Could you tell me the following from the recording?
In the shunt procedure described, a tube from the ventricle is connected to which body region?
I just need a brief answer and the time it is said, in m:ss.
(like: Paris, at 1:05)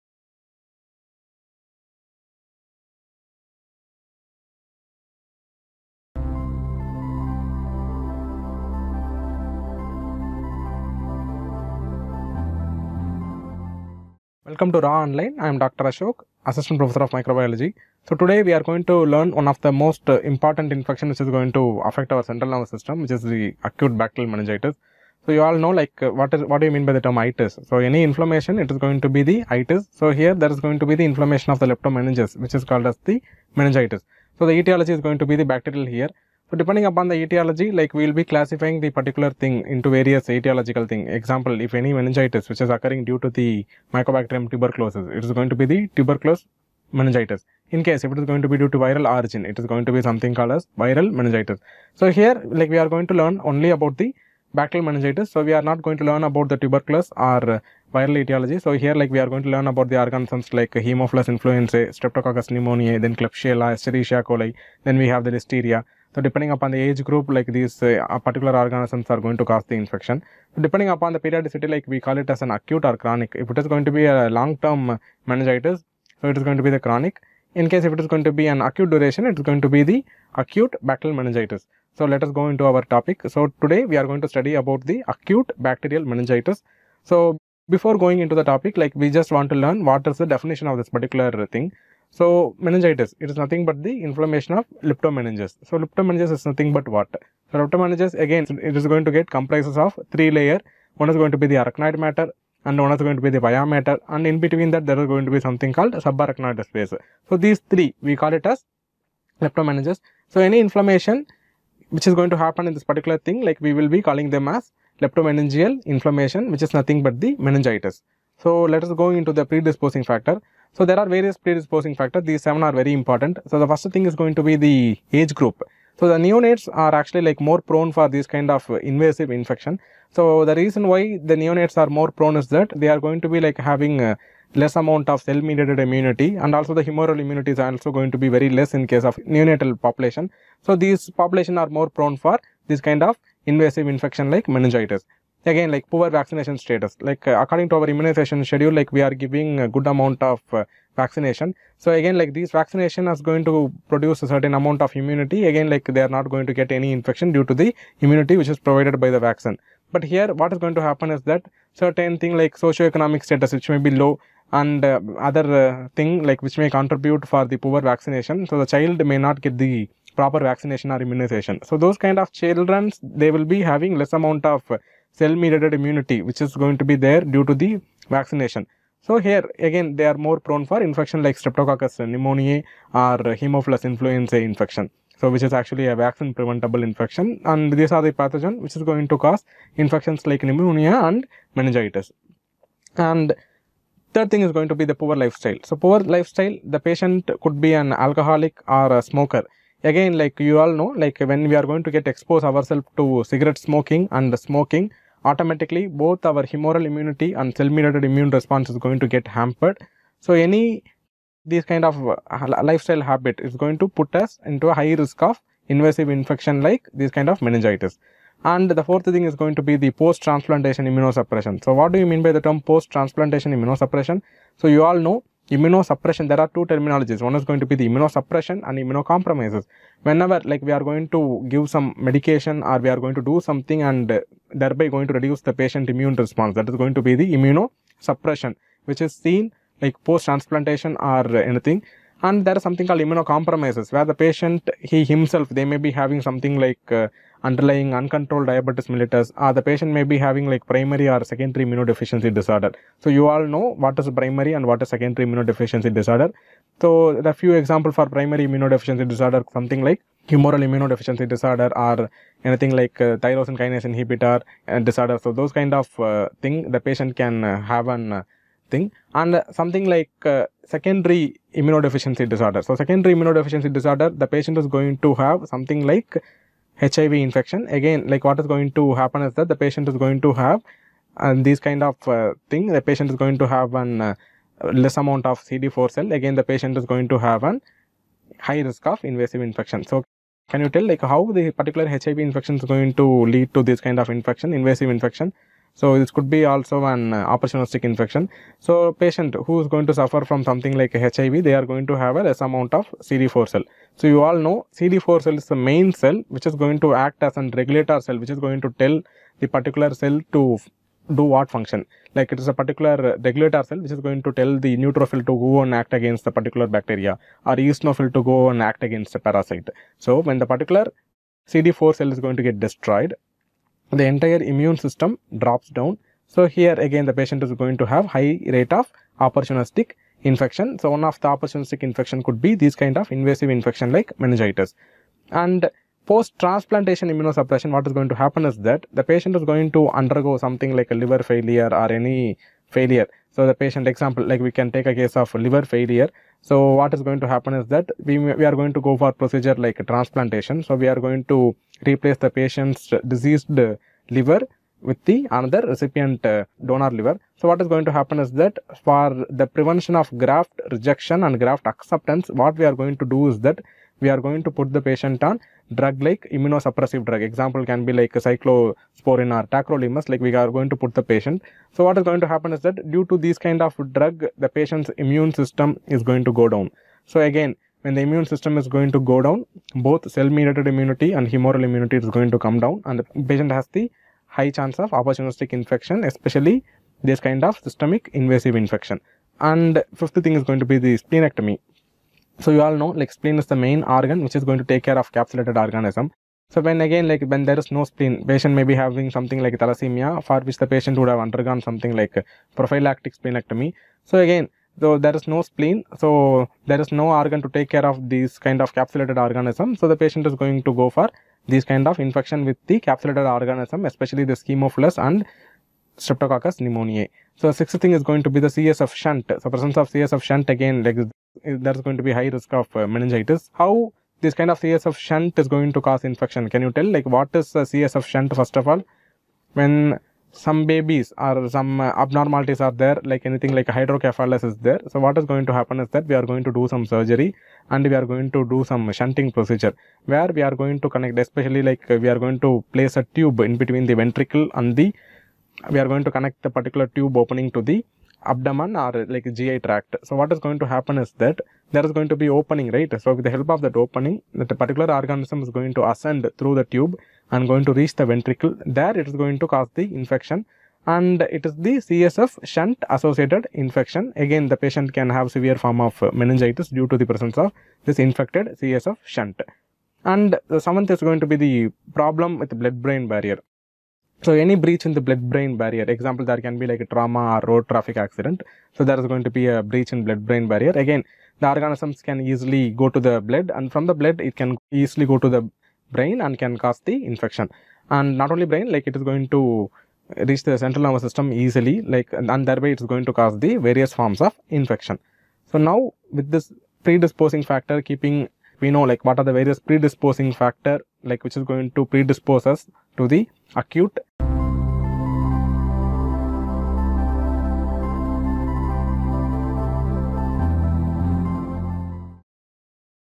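the abdomen, at 7:28.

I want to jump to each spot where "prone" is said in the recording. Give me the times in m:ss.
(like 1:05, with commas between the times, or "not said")
2:07, 2:12, 2:21, 3:00.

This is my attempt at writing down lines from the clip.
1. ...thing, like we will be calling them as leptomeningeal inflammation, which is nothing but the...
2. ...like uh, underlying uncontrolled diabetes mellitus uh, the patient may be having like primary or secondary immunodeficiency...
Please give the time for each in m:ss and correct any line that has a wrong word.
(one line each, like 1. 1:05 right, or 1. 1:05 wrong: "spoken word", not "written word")
1. 1:53 right
2. 4:06 right.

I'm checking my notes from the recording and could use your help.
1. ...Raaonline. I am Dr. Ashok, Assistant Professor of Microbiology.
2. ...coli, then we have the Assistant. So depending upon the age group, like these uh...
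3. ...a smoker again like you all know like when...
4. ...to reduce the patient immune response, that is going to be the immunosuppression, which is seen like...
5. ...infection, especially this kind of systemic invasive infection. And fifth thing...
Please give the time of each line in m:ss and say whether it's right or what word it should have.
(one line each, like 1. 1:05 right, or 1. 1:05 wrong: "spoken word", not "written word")
1. 0:14 right
2. 1:04 wrong: "Listeria", not "Assistant"
3. 3:18 right
4. 3:55 right
5. 6:25 right.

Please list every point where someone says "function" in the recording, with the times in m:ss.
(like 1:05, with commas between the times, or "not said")
5:11.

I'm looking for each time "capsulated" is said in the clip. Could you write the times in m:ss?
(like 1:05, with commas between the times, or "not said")
6:35, 6:48, 6:52.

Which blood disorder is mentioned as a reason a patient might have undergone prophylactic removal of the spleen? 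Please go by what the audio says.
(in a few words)
thalassemia.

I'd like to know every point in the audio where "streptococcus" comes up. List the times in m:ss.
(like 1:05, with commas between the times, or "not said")
1:01, 3:01, 6:55.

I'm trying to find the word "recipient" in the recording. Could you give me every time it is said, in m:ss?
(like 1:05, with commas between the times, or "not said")
5:55.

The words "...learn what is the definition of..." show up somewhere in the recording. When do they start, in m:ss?
1:29.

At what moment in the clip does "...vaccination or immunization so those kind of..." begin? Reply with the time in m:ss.
2:50.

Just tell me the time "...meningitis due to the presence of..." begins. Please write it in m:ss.
7:46.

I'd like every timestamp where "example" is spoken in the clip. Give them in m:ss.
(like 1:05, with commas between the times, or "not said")
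0:41, 4:17, 5:43, 6:07, 7:55.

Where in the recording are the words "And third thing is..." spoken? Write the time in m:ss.
3:12.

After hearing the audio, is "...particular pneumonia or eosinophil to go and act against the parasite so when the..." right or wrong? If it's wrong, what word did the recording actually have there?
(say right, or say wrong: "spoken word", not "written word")
wrong: "bacteria", not "pneumonia".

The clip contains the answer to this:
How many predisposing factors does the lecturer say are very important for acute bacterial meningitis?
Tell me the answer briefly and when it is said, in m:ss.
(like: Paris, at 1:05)
7, at 2:02.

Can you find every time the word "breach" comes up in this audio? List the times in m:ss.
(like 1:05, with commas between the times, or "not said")
7:54, 7:59.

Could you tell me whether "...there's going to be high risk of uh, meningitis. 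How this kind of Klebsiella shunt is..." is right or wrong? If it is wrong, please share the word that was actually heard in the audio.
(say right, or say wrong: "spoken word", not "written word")
wrong: "CSF", not "Klebsiella".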